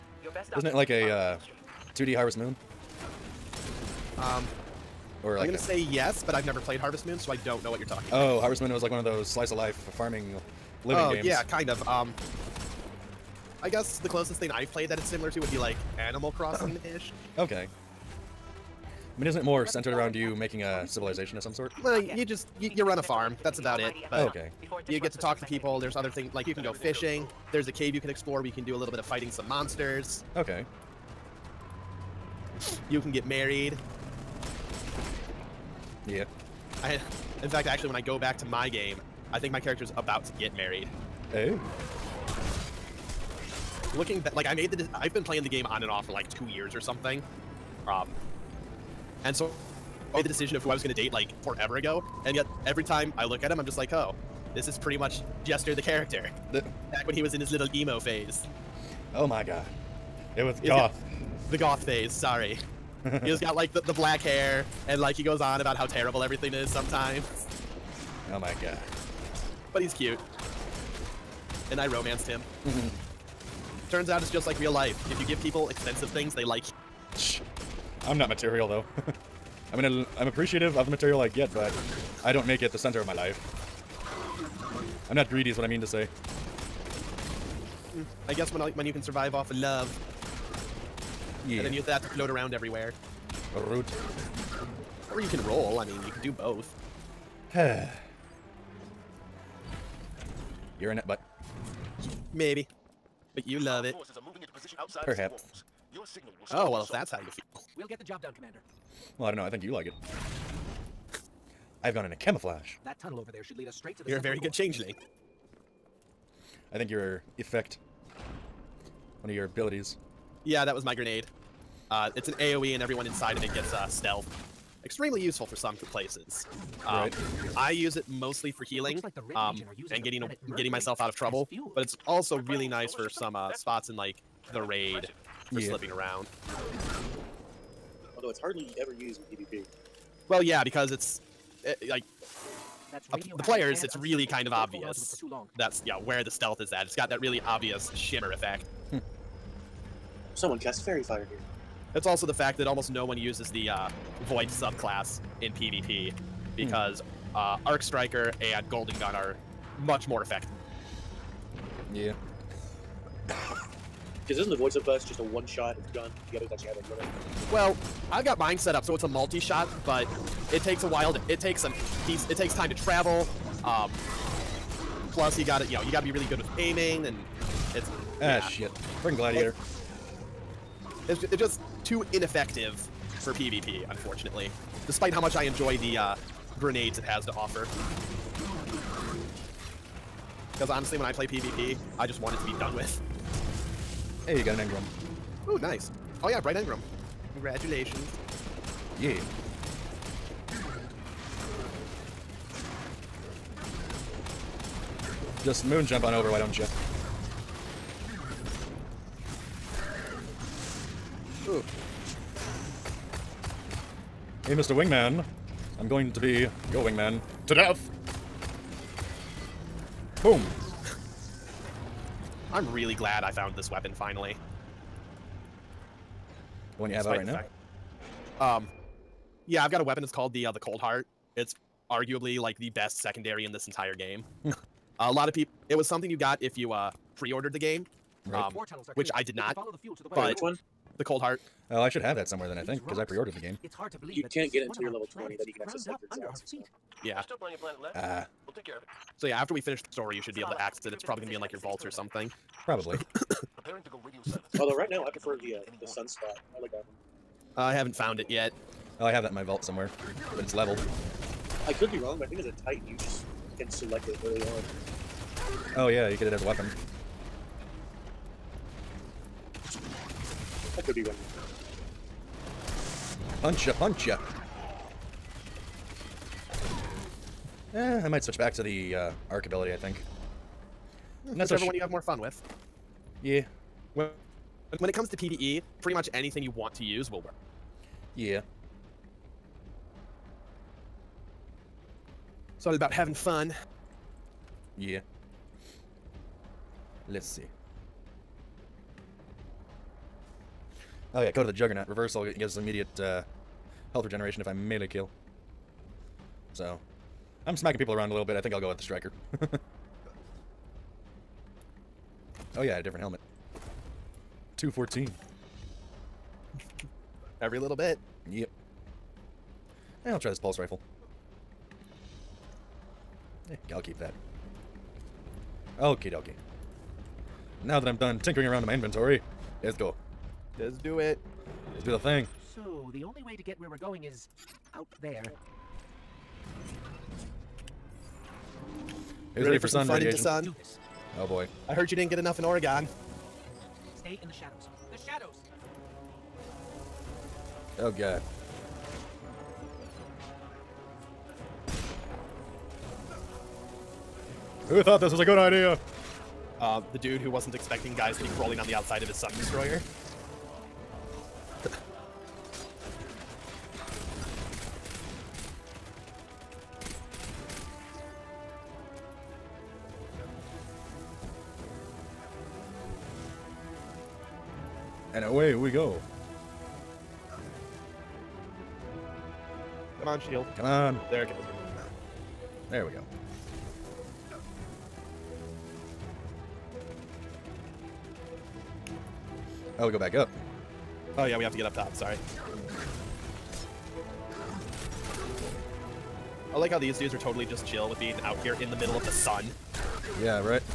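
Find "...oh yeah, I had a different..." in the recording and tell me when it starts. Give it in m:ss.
5:12.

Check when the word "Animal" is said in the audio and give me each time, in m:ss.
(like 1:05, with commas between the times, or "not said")
0:15.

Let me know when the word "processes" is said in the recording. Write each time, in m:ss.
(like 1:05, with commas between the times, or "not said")
not said.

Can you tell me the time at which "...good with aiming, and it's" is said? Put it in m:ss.
2:56.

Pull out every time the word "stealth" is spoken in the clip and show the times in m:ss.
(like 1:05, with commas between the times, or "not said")
2:03, 2:26.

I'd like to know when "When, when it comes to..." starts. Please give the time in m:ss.
4:43.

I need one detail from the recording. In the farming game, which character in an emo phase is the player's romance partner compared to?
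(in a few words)
Jestre.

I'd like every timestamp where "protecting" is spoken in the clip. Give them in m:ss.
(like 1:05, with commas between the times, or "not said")
not said.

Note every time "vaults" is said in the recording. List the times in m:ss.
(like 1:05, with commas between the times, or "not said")
4:11, 4:19.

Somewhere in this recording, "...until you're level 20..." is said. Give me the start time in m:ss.
4:04.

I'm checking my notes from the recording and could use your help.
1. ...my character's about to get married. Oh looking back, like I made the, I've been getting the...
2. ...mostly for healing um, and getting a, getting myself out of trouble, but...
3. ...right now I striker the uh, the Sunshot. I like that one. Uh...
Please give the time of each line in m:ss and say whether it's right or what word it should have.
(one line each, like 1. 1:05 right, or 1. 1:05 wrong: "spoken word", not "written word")
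1. 0:39 wrong: "playing", not "getting"
2. 2:08 right
3. 4:14 wrong: "prefer", not "striker".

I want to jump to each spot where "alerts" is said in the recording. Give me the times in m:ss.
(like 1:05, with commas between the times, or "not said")
not said.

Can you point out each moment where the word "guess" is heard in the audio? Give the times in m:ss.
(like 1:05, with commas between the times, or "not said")
0:13, 1:28.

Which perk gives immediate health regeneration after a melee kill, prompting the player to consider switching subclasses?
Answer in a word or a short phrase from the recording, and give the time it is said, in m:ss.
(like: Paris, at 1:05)
Code of the Juggernaut, at 5:01.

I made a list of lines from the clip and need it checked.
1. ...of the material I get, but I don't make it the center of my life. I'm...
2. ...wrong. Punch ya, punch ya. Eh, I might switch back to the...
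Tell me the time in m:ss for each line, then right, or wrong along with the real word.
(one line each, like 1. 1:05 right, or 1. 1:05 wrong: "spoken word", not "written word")
1. 1:20 right
2. 4:31 right.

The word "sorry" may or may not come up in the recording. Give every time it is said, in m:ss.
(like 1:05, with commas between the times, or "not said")
1:02, 6:31.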